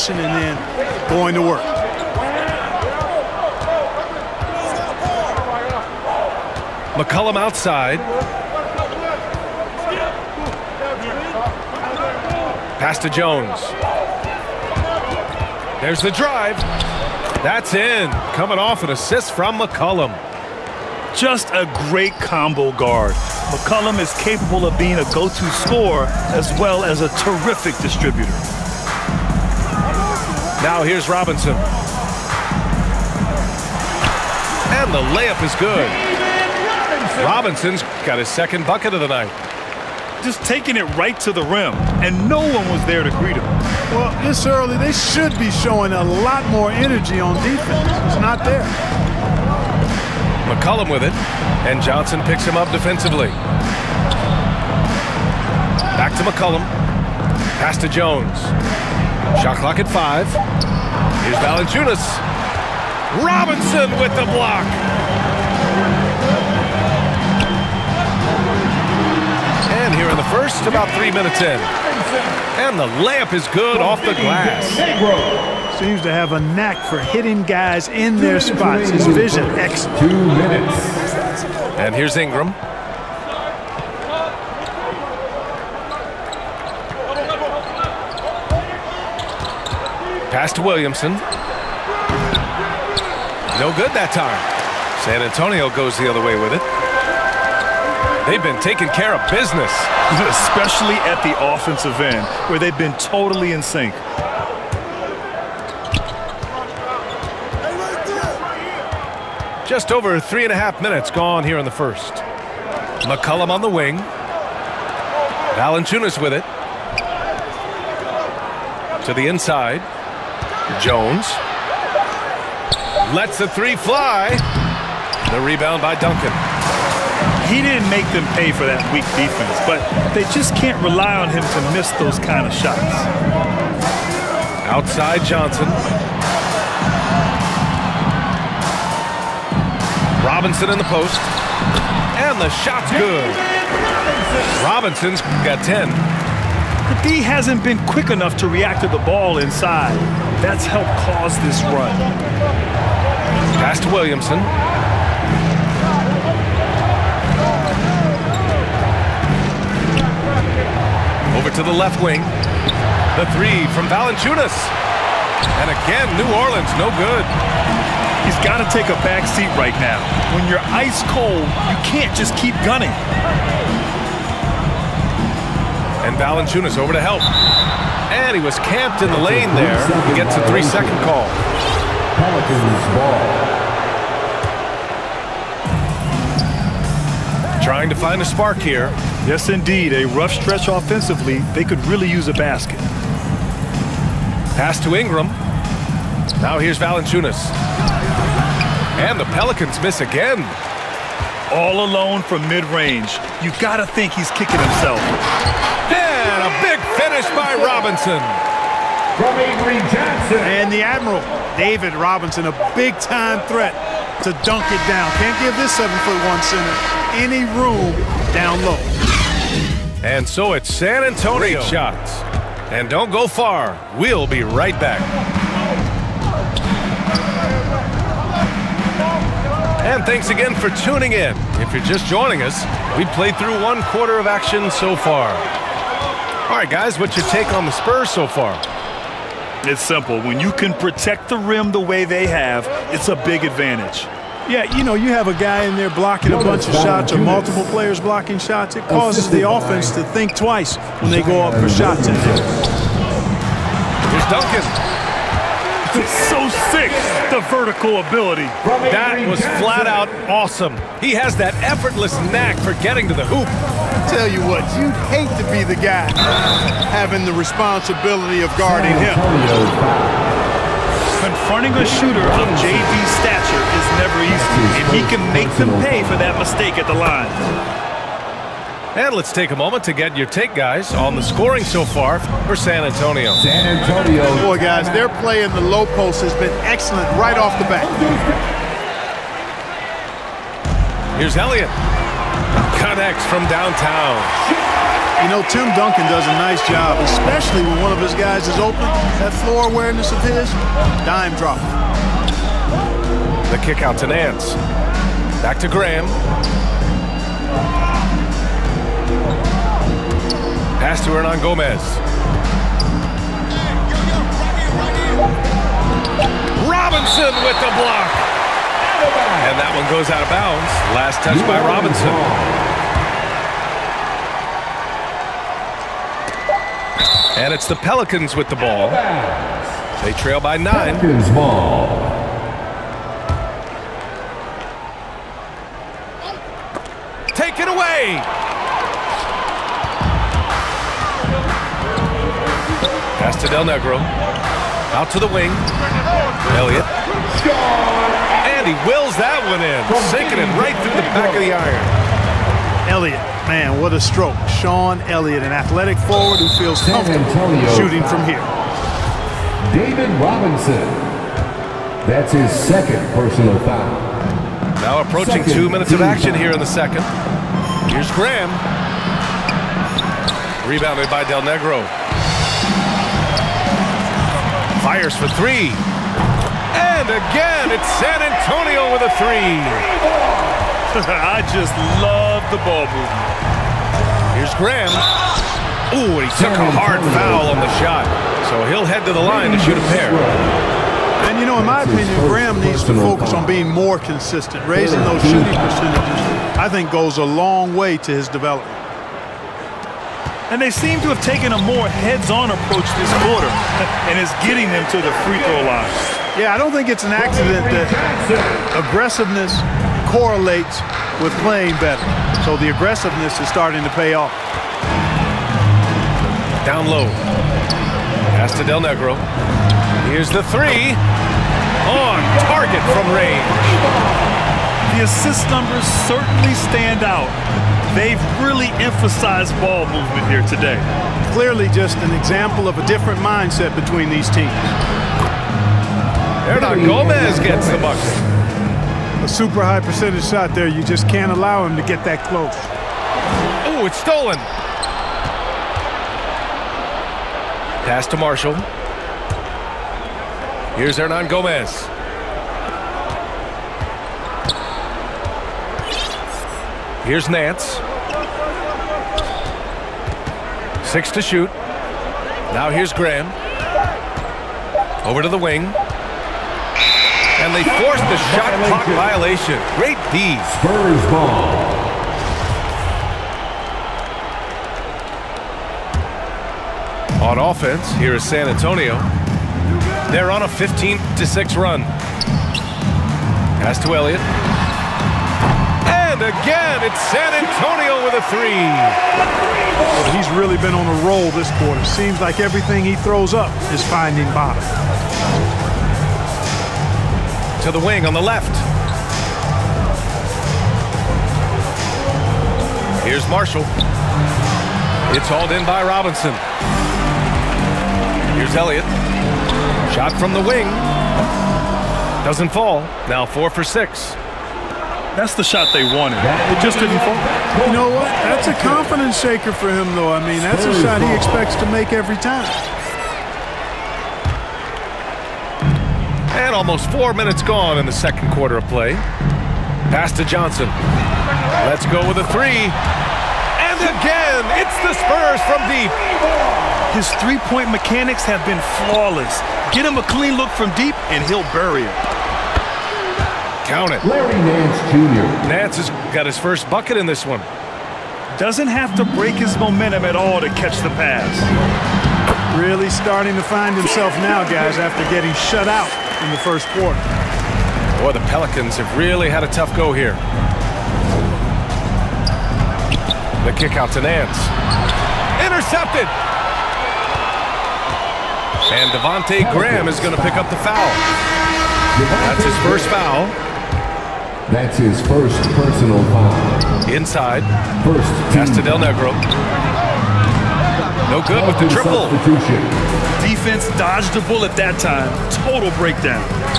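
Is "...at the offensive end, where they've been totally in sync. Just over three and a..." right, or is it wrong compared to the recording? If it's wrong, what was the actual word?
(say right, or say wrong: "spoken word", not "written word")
right.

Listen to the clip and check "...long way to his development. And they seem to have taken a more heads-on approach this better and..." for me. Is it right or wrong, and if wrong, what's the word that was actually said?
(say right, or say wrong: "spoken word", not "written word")
wrong: "quarter", not "better".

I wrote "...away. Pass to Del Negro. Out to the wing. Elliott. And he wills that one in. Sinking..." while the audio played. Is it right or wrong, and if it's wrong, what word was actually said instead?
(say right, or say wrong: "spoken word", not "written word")
right.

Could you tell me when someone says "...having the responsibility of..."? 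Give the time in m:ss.
4:26.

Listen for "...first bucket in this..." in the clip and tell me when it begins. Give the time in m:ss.
9:06.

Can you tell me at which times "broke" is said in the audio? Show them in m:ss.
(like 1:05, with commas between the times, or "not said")
not said.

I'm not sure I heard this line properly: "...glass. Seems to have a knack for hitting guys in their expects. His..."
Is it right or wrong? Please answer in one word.
wrong.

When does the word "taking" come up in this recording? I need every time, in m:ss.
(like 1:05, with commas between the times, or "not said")
0:40, 1:38.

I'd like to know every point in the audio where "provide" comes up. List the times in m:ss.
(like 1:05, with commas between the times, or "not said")
not said.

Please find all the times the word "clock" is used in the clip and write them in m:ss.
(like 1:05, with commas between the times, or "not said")
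0:59, 7:48.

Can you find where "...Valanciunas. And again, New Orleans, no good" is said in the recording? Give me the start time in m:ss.
2:43.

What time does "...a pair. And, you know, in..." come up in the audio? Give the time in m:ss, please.
6:29.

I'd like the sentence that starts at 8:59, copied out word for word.
Get him a clean look from deep, and he'll bury it.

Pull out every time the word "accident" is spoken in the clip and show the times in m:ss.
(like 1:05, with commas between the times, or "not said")
6:47.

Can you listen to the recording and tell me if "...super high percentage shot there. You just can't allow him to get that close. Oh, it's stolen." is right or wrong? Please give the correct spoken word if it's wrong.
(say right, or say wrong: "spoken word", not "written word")
right.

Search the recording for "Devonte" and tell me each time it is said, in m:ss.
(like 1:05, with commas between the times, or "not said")
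9:28.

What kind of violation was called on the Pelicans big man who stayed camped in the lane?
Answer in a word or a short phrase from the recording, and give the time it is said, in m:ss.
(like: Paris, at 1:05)
three-second call, at 3:00.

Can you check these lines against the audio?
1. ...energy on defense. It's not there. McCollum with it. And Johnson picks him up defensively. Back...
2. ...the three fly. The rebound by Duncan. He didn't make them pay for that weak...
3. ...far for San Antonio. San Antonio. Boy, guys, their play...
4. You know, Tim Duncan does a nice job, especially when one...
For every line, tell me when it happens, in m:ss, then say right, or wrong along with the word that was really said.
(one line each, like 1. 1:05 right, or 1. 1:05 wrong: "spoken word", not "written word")
1. 0:46 right
2. 2:03 right
3. 4:41 right
4. 4:55 right.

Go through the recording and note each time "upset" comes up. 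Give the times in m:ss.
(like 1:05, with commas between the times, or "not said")
not said.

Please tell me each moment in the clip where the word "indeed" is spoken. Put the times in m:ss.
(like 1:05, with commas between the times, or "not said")
3:09.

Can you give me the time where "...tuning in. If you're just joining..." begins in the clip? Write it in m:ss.
3:50.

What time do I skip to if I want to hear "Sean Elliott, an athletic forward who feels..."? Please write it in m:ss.
5:54.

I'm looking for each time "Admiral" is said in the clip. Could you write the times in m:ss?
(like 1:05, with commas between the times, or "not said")
3:30.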